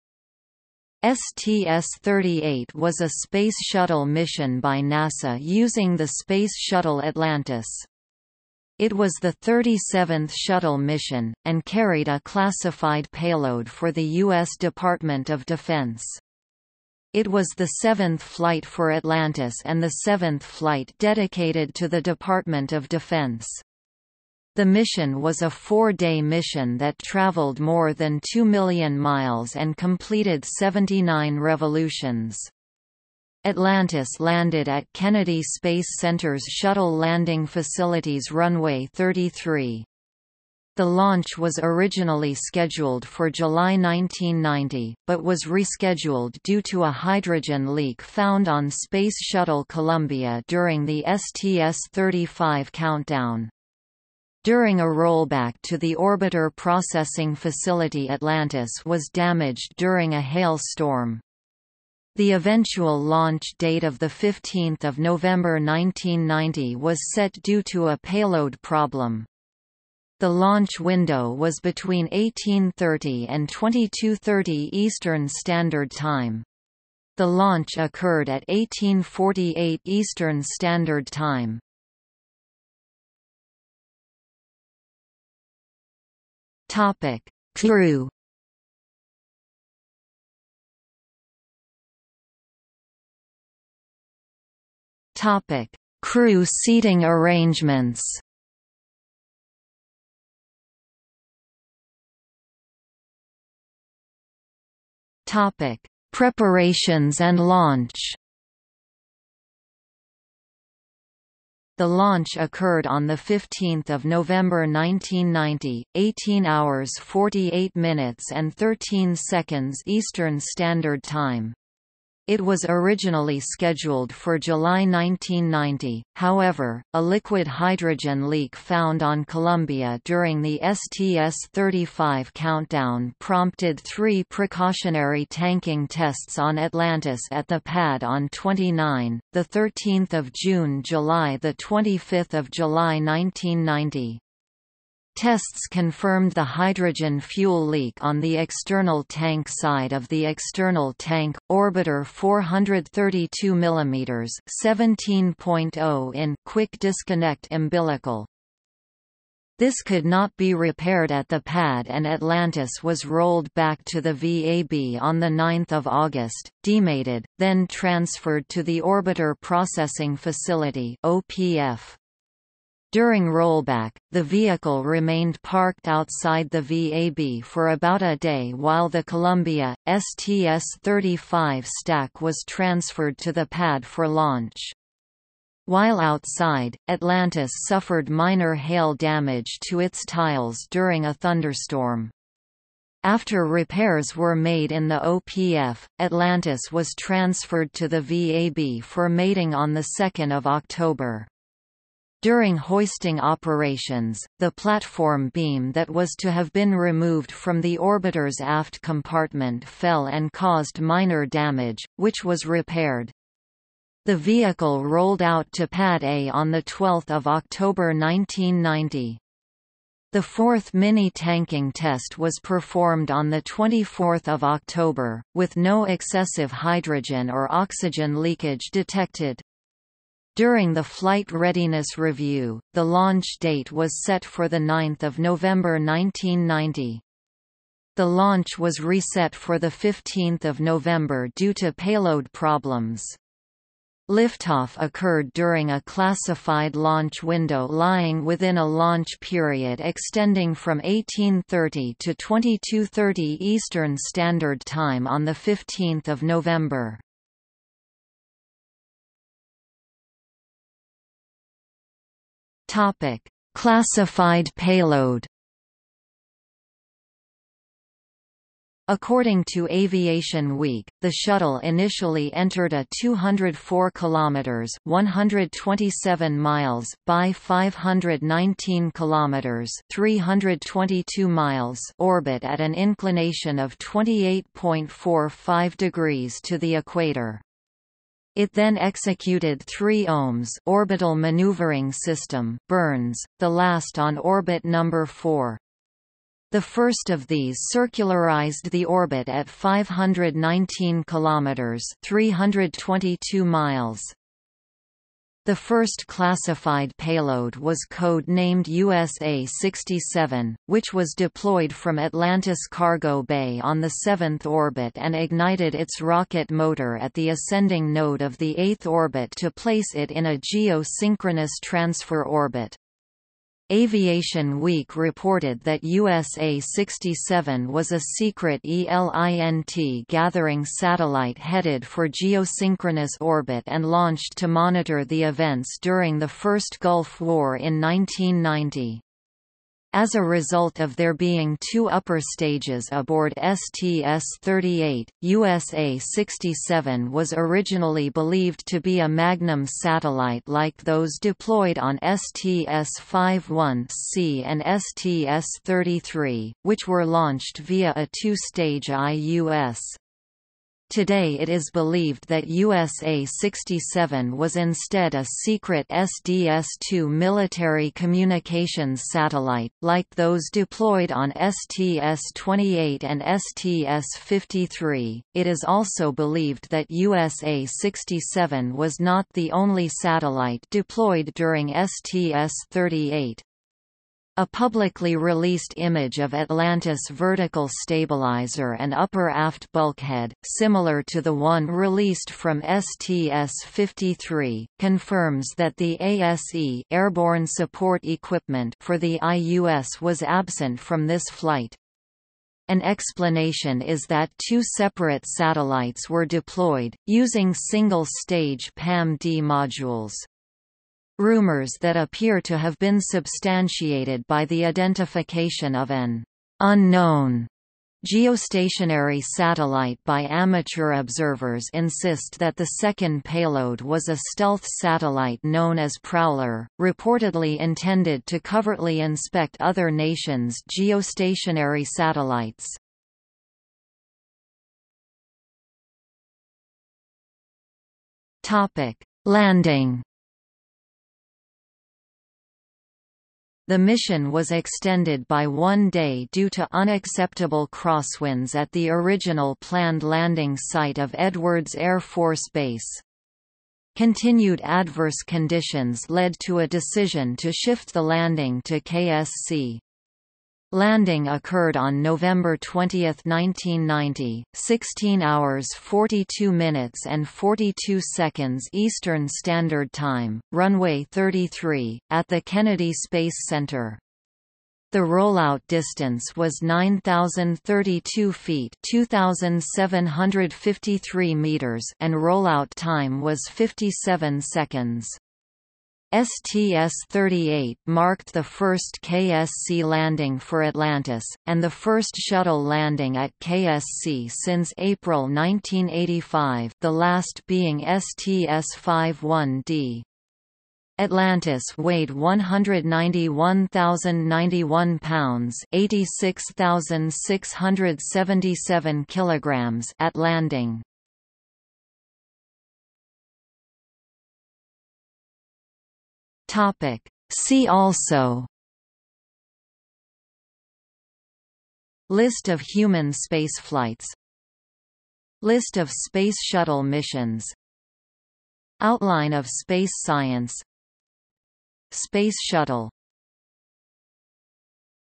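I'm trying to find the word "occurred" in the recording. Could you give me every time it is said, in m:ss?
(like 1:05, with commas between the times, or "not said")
1:17, 1:52, 4:04, 7:41.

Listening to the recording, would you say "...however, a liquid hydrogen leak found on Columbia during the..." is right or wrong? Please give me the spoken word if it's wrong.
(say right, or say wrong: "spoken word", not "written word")
right.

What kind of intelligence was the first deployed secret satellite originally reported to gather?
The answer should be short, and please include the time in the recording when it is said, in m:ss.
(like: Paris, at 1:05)
ELINT, at 5:28.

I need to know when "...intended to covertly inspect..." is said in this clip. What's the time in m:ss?
7:07.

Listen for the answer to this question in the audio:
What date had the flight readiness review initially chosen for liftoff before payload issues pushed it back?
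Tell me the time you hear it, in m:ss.
3:54.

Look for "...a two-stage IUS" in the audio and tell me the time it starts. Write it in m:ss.
5:57.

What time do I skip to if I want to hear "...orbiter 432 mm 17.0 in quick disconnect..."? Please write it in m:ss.
2:31.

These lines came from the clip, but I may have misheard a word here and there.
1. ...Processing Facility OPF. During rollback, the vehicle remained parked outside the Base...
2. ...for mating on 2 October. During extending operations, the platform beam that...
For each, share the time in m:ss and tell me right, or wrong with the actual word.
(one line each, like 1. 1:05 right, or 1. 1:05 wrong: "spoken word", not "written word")
1. 2:49 wrong: "VAB", not "Base"
2. 3:18 wrong: "hoisting", not "extending".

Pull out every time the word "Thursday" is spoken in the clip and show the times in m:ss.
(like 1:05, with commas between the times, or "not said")
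not said.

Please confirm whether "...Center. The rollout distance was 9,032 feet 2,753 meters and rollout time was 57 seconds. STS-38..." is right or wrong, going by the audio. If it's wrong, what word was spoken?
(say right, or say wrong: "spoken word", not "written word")
right.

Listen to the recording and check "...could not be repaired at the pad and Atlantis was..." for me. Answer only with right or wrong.
right.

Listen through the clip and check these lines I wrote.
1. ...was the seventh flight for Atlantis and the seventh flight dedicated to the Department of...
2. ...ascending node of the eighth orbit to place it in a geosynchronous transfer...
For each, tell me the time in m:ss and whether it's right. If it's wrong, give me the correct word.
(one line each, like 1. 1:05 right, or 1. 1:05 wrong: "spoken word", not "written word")
1. 0:17 right
2. 5:17 right.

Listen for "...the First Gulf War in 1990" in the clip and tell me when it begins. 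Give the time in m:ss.
5:36.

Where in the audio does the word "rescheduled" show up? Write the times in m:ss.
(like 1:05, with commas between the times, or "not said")
0:45.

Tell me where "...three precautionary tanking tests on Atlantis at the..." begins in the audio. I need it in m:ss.
2:13.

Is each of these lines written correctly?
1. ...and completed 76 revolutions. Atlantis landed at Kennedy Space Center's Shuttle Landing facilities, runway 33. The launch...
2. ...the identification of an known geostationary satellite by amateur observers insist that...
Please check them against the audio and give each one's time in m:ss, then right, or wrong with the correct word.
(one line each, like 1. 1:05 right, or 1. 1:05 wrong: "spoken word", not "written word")
1. 0:29 wrong: "79", not "76"
2. 6:54 wrong: "unknown", not "known".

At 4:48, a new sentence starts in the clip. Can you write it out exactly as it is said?
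It then executed three OMS orbital maneuvering system burns, the last on orbit number 4.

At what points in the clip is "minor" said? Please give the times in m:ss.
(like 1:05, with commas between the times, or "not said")
3:08, 3:30.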